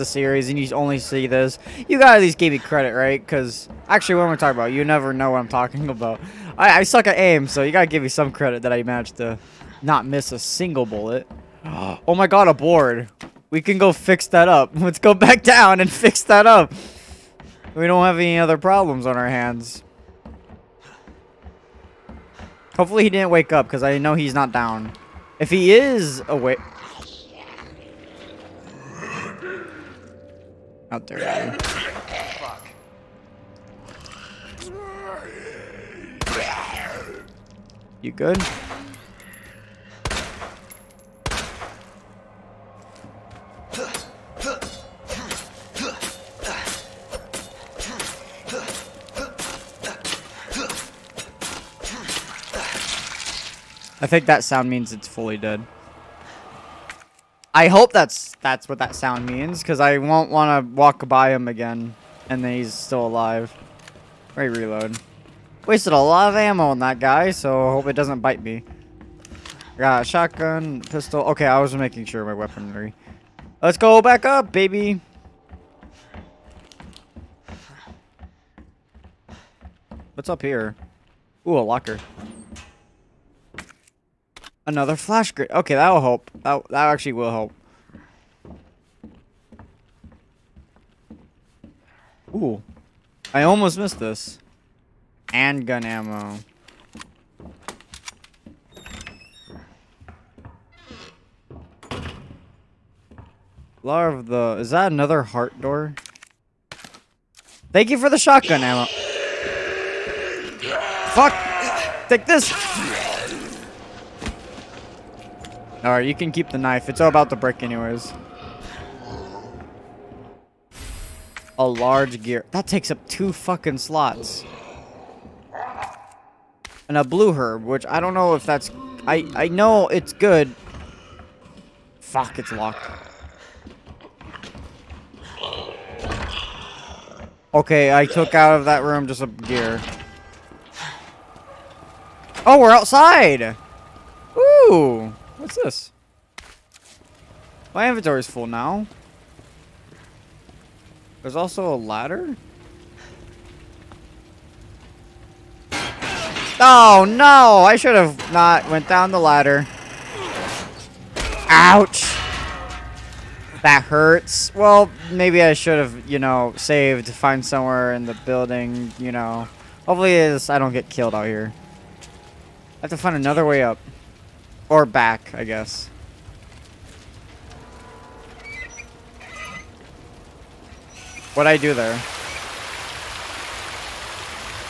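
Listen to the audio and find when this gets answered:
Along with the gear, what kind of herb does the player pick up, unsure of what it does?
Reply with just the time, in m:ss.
2:07.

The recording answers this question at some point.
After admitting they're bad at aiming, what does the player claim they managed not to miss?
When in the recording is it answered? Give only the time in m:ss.
0:10.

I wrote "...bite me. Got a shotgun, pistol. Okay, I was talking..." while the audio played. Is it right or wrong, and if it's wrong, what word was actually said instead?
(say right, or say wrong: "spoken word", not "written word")
wrong: "making", not "talking".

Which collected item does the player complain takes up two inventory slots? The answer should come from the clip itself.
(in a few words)
A large gear.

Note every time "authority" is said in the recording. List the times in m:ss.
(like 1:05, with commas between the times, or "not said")
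not said.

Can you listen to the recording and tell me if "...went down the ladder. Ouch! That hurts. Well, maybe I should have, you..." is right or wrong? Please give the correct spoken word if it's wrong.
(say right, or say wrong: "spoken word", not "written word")
right.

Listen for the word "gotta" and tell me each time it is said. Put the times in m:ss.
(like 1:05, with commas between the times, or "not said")
0:01, 0:07.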